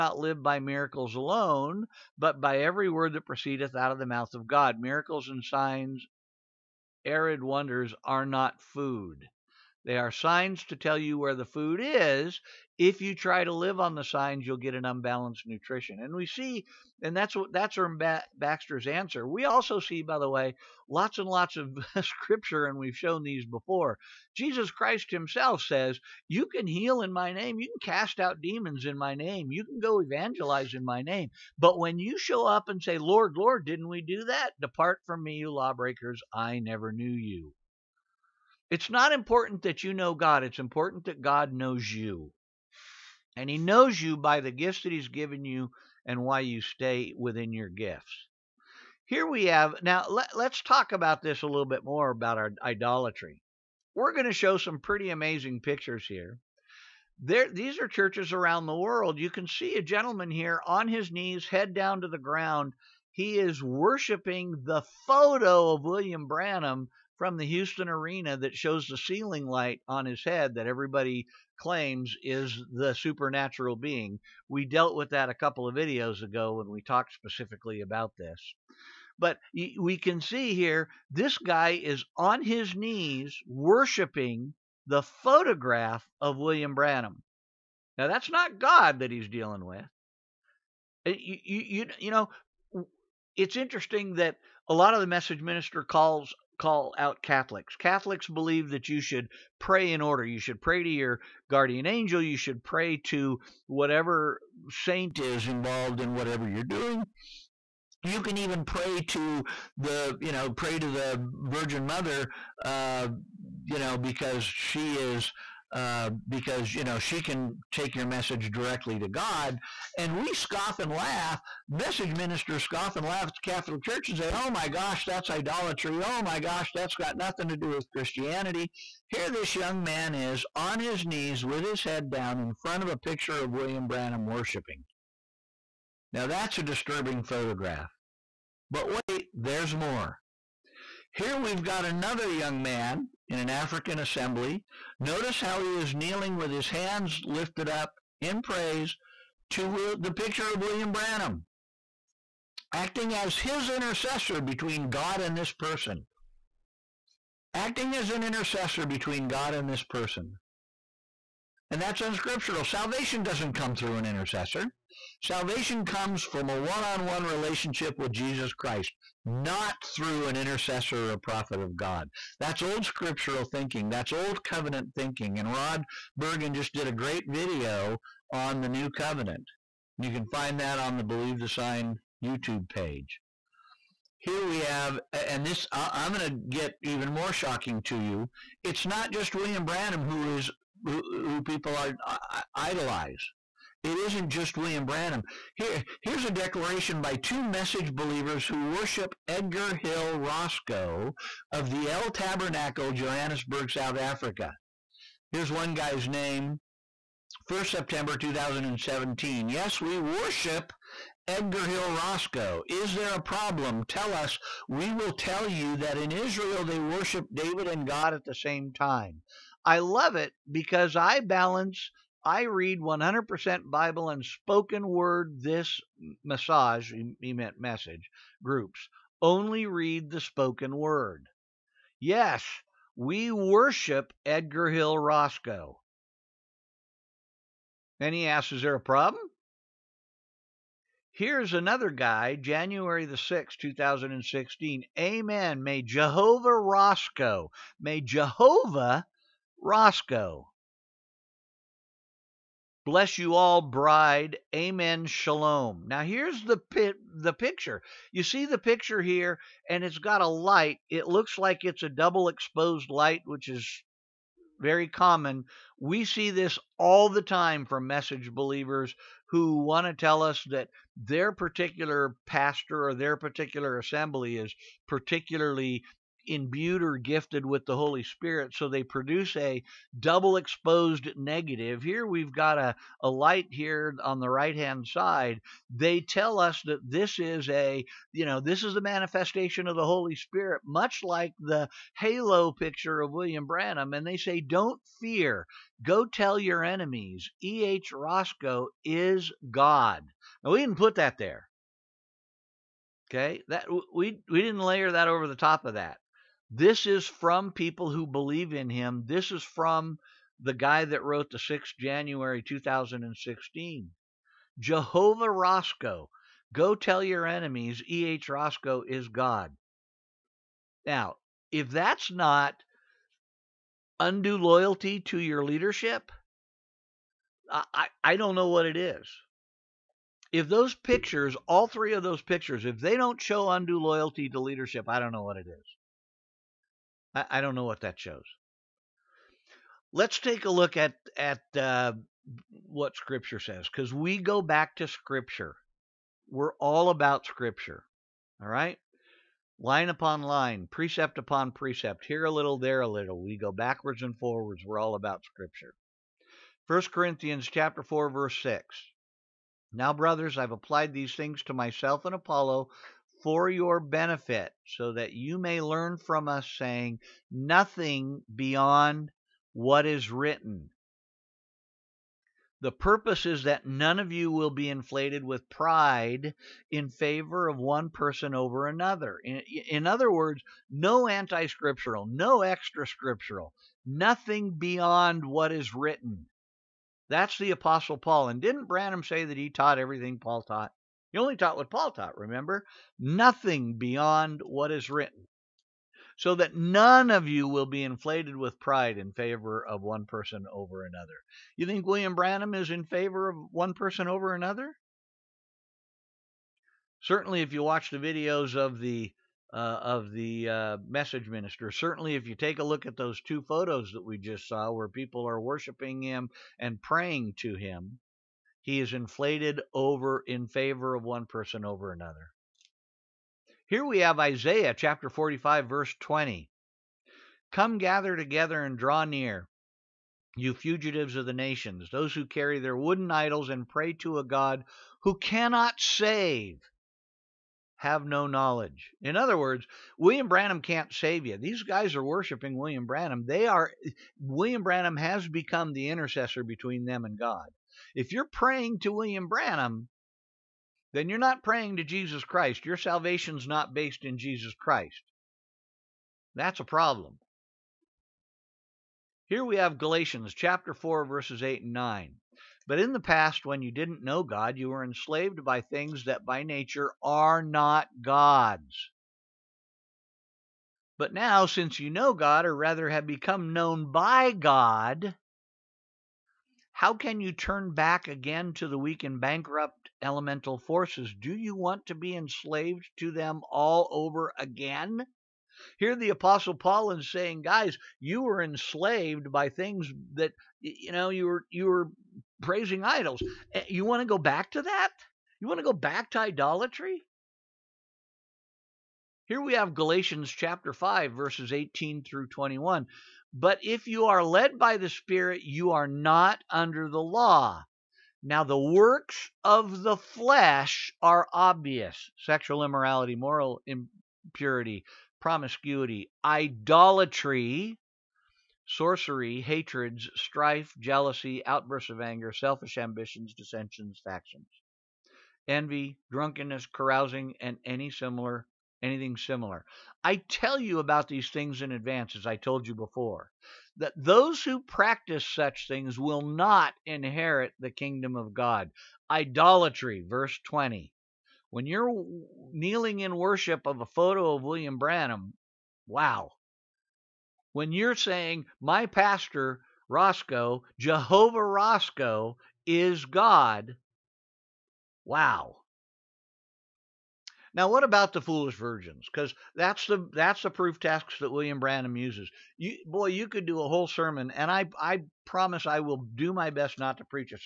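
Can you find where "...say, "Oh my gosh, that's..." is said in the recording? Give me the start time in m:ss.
2:04.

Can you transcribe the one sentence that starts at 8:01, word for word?
Do you want to be enslaved to them all over again?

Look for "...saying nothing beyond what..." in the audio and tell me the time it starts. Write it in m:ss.
6:06.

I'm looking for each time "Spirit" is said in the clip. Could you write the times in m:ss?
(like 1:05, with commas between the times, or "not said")
4:38, 4:50, 8:24.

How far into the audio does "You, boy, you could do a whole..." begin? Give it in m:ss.
9:22.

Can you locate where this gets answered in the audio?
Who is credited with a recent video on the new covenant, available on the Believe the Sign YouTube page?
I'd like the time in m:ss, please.
2:55.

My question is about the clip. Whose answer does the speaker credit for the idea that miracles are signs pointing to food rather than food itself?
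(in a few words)
Erm Baxter.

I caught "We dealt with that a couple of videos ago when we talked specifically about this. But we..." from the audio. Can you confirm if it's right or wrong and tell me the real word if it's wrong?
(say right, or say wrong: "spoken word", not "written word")
right.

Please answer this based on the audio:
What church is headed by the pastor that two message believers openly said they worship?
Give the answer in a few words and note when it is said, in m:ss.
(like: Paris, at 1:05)
El Tabernacle, at 3:21.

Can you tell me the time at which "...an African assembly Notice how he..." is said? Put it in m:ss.
2:23.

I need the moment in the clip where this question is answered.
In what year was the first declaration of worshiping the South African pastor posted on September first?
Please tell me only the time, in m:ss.
3:28.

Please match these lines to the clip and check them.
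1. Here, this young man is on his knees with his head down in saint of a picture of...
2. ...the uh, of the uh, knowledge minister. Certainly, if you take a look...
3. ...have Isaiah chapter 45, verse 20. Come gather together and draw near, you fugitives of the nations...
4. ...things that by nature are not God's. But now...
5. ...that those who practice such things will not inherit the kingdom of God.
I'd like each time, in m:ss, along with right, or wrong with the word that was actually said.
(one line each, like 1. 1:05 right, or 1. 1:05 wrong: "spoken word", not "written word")
1. 2:09 wrong: "front", not "saint"
2. 6:48 wrong: "message", not "knowledge"
3. 7:03 right
4. 7:45 right
5. 8:53 right.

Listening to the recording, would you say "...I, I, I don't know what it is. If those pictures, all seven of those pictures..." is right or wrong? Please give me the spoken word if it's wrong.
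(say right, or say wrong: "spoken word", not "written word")
wrong: "three", not "seven".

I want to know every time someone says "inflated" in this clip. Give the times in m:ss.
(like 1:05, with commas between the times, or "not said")
6:14, 6:37, 6:58.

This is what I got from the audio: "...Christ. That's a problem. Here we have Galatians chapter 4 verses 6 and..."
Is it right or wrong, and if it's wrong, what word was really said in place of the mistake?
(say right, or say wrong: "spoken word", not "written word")
wrong: "8", not "6".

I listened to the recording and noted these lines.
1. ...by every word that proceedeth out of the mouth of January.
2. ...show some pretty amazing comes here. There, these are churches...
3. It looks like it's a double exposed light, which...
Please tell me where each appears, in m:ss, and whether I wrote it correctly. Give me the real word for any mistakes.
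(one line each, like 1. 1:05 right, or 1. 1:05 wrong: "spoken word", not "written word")
1. 0:02 wrong: "God", not "January"
2. 0:54 wrong: "pictures", not "comes"
3. 4:20 right.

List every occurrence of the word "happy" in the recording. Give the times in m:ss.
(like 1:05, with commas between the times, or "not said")
not said.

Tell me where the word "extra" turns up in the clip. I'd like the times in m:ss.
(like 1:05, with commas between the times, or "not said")
6:22.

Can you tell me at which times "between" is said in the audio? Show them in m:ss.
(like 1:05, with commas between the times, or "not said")
2:34, 2:38, 7:26.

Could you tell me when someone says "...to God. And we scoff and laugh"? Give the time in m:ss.
1:58.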